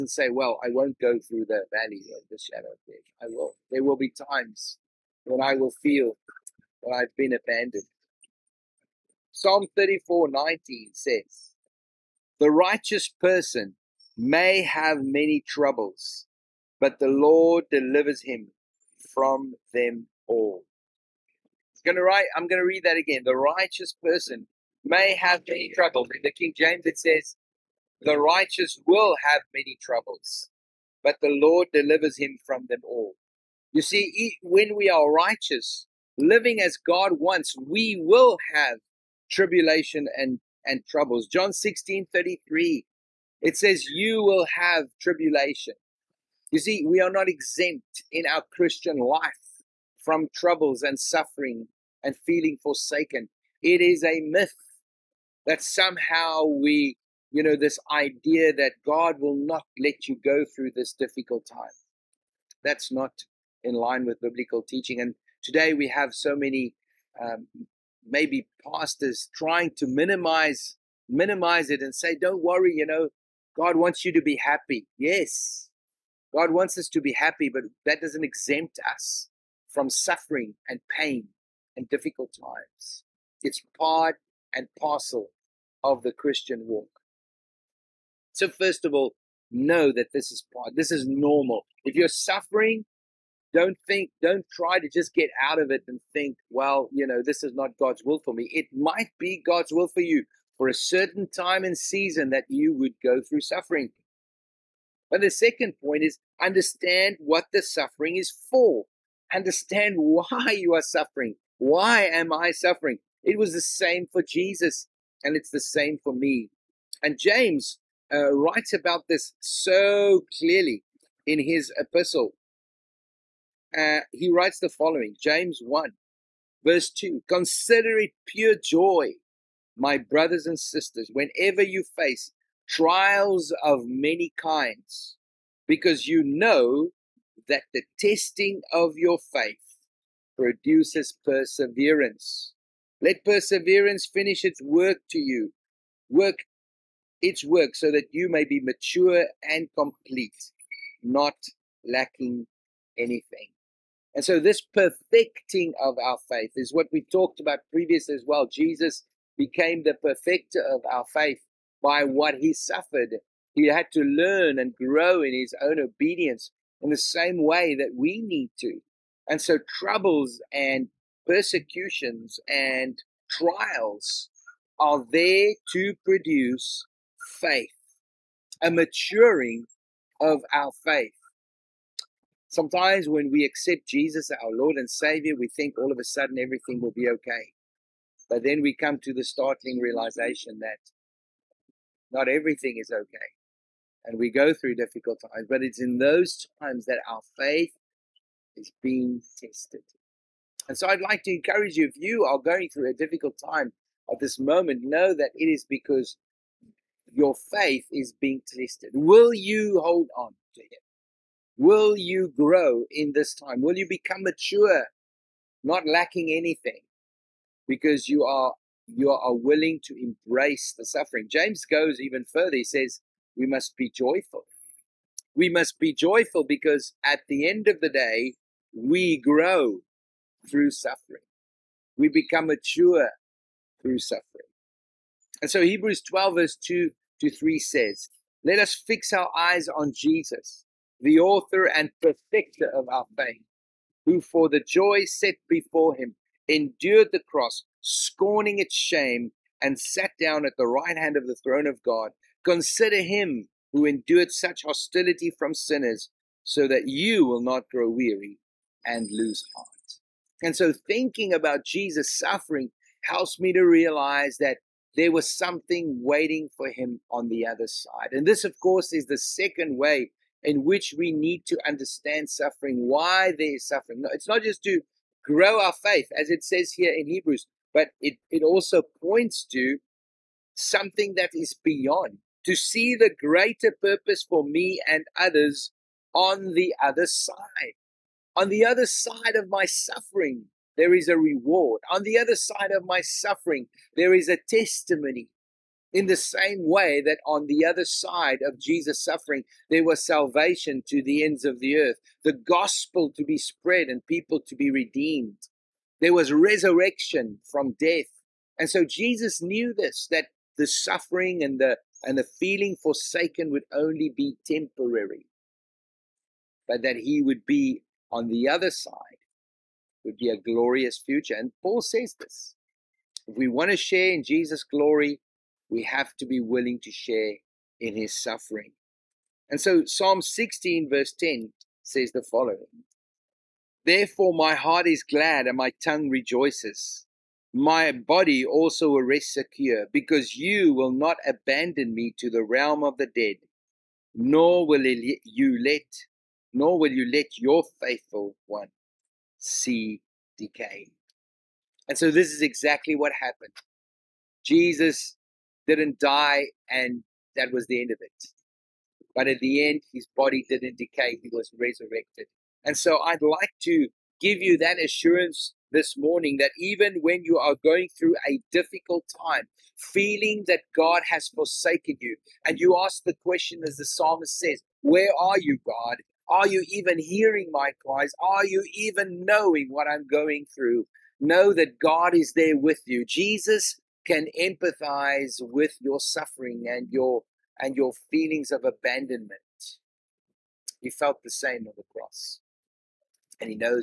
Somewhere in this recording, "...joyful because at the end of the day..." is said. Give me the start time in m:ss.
3:45.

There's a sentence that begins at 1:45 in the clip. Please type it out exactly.
But the second point is understand what the suffering is for.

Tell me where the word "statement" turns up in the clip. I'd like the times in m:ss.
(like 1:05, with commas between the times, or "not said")
not said.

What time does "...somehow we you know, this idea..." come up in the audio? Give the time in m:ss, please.
0:55.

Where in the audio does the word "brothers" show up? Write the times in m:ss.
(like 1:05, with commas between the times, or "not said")
2:09.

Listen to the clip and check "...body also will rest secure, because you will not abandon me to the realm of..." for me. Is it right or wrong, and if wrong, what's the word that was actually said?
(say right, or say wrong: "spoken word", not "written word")
right.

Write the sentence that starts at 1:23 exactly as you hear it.
It's part and parcel of the Christian walk.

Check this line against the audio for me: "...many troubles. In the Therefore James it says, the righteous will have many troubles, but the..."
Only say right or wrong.
wrong.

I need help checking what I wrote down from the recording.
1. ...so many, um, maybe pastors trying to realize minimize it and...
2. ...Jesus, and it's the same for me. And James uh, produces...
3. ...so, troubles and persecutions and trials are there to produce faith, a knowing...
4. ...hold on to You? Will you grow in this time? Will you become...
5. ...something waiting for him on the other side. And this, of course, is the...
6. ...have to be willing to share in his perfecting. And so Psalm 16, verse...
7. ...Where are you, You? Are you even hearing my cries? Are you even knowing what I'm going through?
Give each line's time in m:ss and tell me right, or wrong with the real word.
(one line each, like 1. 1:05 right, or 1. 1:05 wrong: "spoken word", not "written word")
1. 1:06 wrong: "minimize", not "realize"
2. 1:54 wrong: "writes", not "produces"
3. 2:49 wrong: "maturing", not "knowing"
4. 3:29 wrong: "Him", not "You"
5. 4:25 right
6. 5:25 wrong: "suffering", not "perfecting"
7. 6:14 wrong: "God", not "You".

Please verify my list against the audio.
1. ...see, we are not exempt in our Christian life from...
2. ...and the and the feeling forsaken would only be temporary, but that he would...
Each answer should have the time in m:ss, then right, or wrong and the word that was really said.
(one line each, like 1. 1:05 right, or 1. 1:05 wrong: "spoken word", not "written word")
1. 0:46 right
2. 5:11 right.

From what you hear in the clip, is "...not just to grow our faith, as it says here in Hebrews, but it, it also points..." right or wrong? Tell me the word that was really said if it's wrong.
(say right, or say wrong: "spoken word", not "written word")
right.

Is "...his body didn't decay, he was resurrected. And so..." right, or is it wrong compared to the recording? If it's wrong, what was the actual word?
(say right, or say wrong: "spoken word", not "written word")
right.